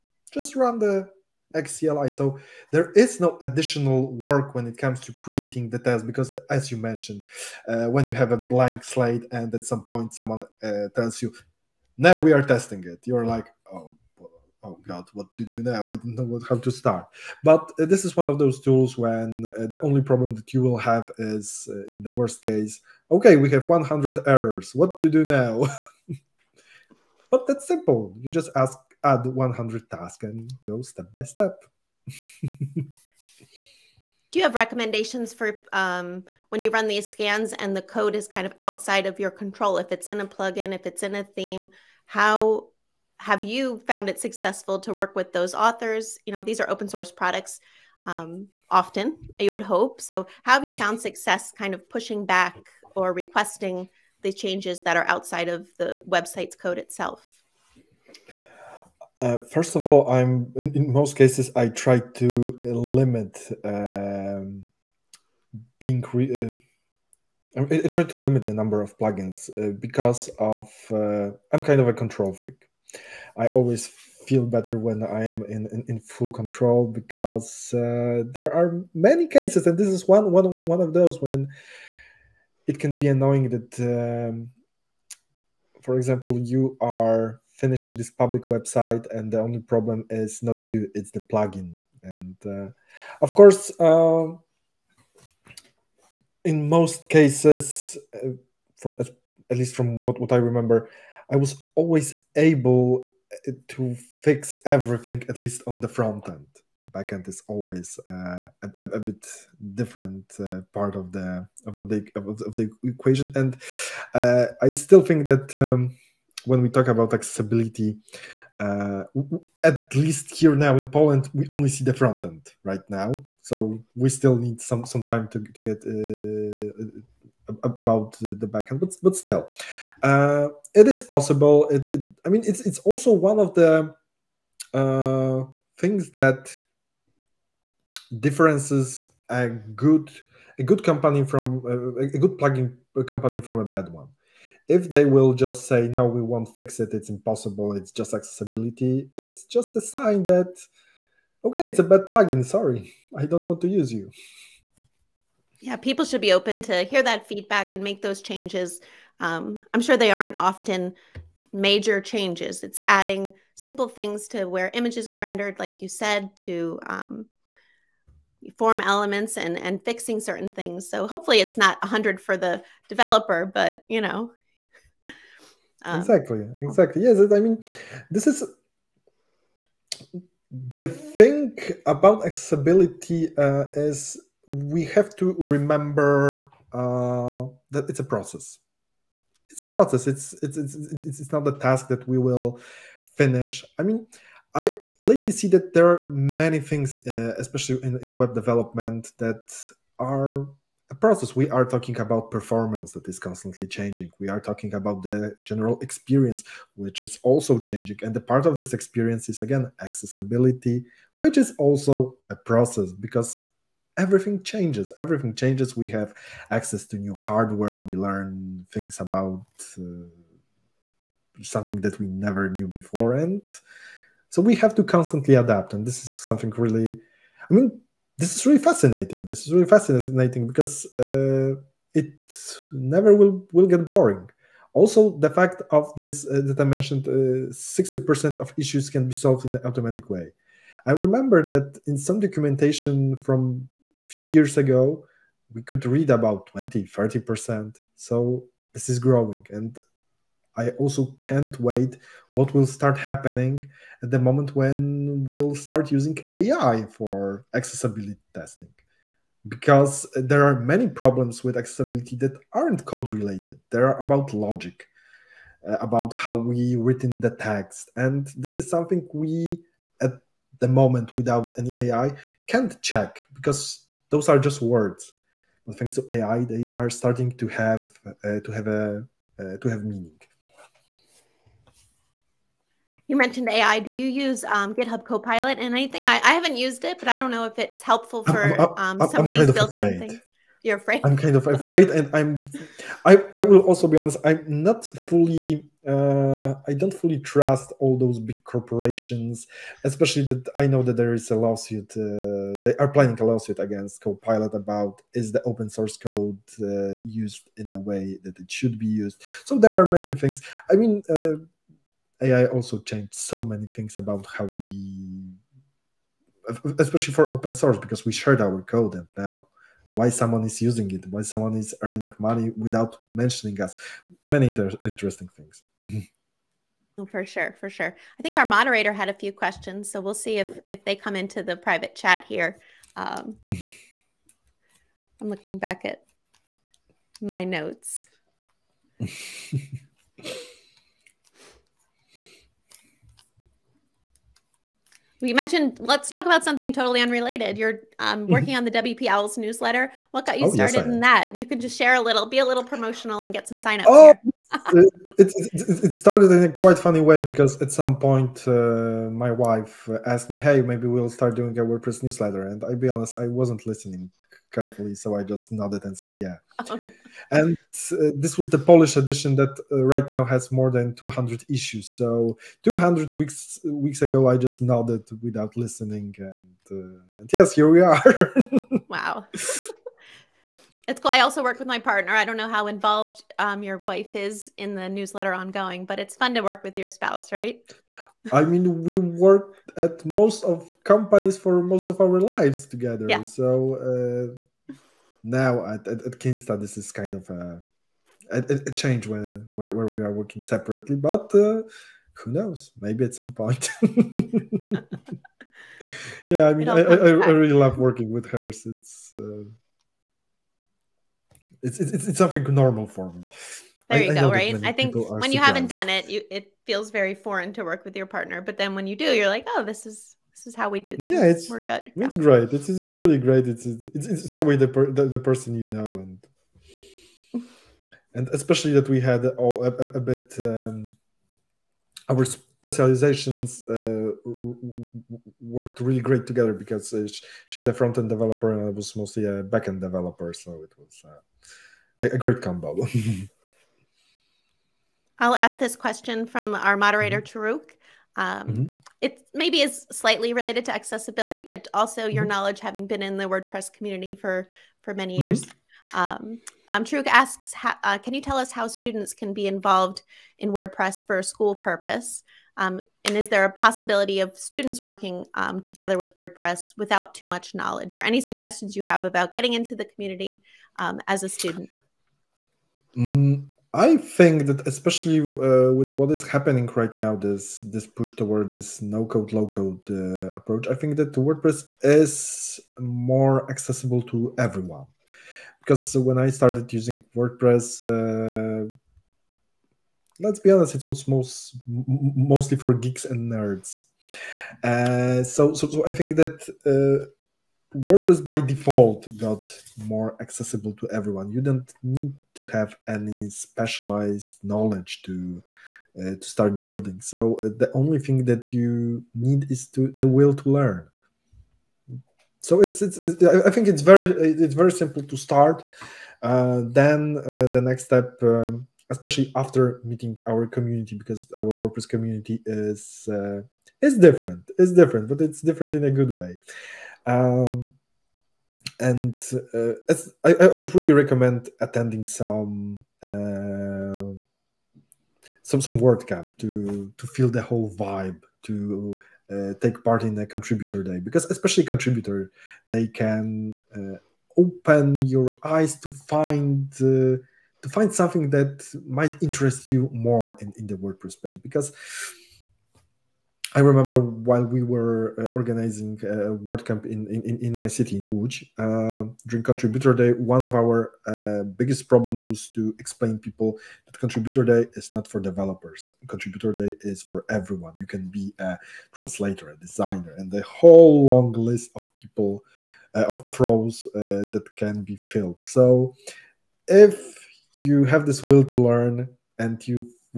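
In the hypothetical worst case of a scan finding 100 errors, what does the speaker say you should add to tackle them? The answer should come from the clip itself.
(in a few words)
100 tasks.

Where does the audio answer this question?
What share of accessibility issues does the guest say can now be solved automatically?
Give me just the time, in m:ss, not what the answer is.
3:57.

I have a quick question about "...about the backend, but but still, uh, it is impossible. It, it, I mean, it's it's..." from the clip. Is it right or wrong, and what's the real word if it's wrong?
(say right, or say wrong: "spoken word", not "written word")
wrong: "possible", not "impossible".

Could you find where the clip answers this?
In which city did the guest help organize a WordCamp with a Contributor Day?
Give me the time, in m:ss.
9:18.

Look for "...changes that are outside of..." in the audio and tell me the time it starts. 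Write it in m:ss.
0:54.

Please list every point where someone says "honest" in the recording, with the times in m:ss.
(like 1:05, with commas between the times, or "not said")
4:53, 6:02, 8:10.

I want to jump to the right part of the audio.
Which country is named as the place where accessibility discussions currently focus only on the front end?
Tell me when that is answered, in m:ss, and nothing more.
2:00.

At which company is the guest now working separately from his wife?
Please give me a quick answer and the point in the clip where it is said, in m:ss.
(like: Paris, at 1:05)
Kinsta, at 6:36.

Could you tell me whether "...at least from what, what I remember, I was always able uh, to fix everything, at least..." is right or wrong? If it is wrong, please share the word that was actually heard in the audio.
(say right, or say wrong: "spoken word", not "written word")
right.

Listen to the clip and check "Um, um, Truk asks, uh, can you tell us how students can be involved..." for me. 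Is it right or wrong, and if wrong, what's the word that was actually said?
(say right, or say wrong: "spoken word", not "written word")
right.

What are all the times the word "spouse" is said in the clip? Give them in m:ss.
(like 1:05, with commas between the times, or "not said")
6:26.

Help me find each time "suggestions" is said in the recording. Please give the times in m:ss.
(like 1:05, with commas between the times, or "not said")
7:48.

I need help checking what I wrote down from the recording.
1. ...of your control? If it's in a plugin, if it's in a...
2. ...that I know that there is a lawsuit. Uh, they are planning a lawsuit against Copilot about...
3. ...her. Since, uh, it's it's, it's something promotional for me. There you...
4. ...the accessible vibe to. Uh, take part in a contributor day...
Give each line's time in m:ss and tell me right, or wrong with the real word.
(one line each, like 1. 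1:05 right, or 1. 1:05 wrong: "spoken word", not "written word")
1. 0:39 right
2. 5:00 right
3. 6:48 wrong: "normal", not "promotional"
4. 8:57 wrong: "whole", not "accessible".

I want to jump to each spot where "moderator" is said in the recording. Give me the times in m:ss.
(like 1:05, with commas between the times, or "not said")
5:28, 7:26.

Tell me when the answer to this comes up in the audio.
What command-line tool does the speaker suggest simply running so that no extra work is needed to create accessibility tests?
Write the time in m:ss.
0:01.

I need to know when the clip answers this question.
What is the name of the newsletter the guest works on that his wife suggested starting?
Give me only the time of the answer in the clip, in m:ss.
5:48.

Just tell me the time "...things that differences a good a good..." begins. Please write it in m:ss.
2:15.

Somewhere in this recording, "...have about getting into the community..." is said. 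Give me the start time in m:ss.
7:48.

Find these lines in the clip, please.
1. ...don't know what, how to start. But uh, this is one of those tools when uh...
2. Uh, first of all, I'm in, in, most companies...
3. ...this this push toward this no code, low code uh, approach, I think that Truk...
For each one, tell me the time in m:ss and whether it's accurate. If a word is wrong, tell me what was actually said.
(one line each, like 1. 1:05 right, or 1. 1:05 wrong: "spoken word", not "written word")
1. 0:15 right
2. 0:59 wrong: "cases", not "companies"
3. 7:57 wrong: "WordPress", not "Truk".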